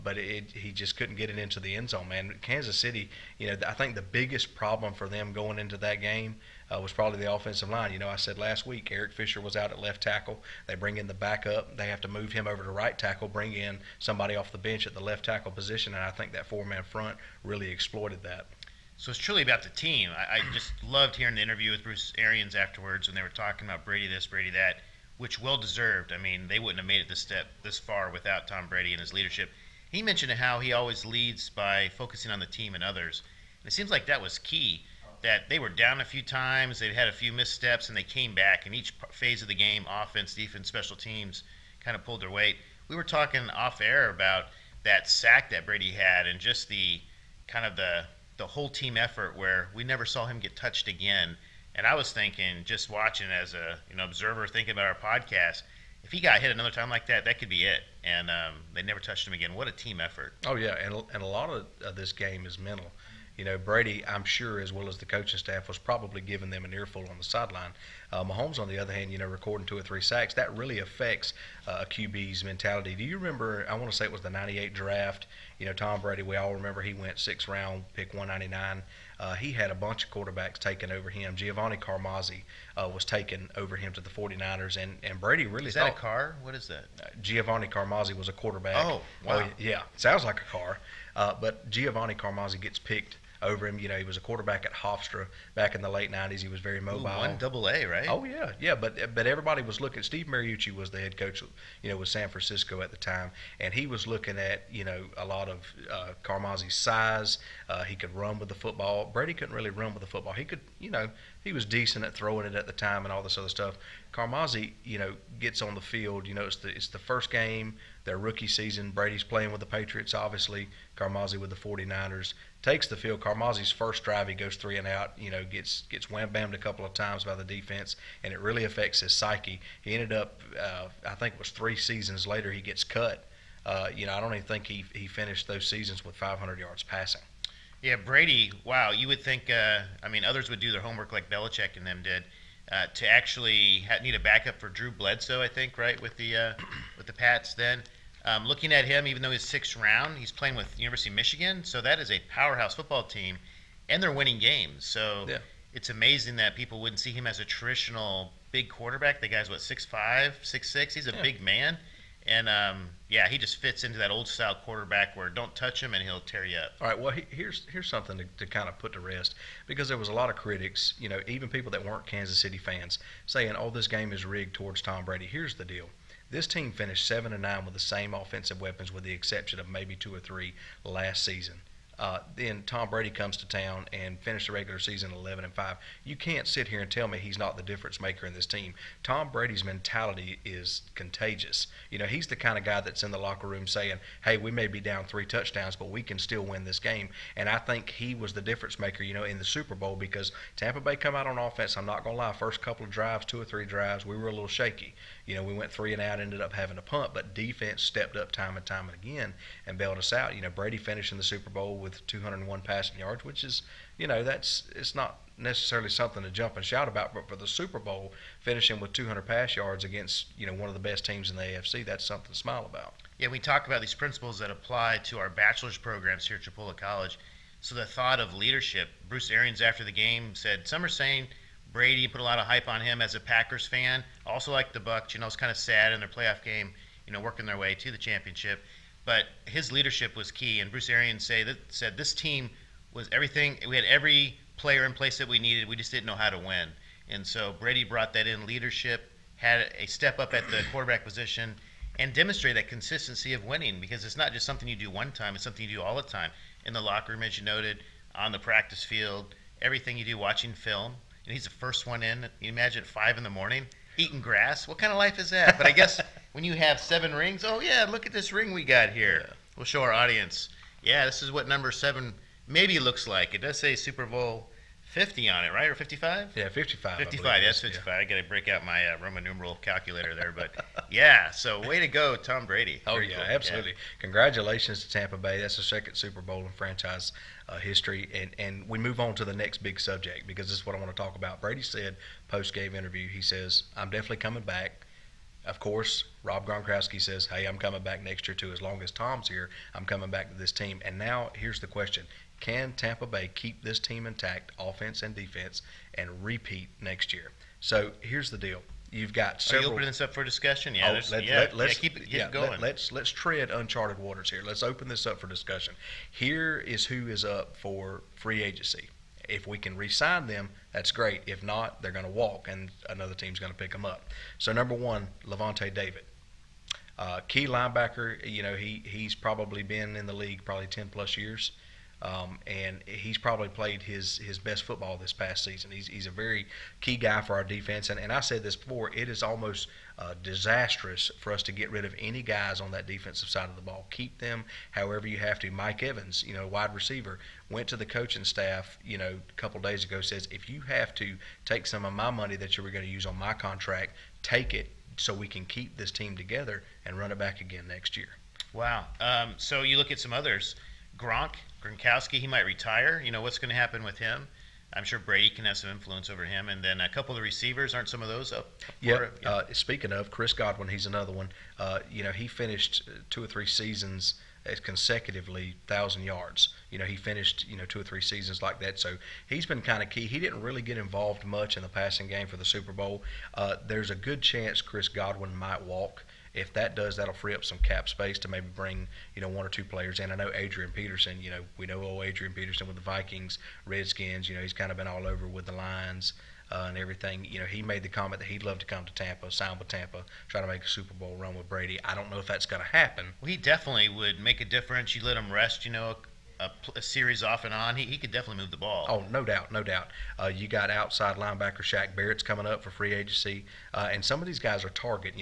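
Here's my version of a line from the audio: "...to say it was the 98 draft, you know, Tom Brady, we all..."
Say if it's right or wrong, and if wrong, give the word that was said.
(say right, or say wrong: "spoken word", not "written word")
right.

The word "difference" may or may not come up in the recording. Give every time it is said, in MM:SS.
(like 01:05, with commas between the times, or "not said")
03:07, 03:18, 06:44.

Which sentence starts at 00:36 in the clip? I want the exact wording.
they had a few missteps, and they came back.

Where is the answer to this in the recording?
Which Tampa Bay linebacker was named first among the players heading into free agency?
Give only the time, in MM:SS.
05:25.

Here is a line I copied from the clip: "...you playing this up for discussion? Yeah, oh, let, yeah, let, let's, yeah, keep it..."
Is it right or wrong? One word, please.
wrong.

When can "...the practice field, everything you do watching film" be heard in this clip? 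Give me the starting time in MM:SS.
04:18.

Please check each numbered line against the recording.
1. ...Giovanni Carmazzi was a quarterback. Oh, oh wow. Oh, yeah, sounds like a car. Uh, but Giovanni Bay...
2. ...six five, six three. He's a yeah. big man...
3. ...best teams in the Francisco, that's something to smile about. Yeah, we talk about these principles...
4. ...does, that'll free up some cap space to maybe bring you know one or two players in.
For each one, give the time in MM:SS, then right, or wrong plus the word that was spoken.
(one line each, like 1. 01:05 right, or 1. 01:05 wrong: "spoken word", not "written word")
1. 01:27 wrong: "Carmazzi", not "Bay"
2. 02:39 wrong: "six", not "three"
3. 03:40 wrong: "AFC", not "Francisco"
4. 06:26 right.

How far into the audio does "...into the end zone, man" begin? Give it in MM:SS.
00:01.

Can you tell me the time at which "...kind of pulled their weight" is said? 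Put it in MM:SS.
00:41.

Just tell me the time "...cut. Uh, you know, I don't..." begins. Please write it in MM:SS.
02:12.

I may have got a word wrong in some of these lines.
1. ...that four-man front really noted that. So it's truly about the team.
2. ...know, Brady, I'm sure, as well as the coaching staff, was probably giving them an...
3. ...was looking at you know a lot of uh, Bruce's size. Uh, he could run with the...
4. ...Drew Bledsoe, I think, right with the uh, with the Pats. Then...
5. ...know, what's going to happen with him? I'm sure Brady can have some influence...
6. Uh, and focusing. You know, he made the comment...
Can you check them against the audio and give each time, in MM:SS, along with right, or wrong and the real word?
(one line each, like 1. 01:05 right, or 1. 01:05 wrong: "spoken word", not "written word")
1. 00:16 wrong: "exploited", not "noted"
2. 01:03 right
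3. 01:43 wrong: "Carmazzi", not "Bruce"
4. 02:24 right
5. 06:03 right
6. 06:36 wrong: "everything", not "focusing".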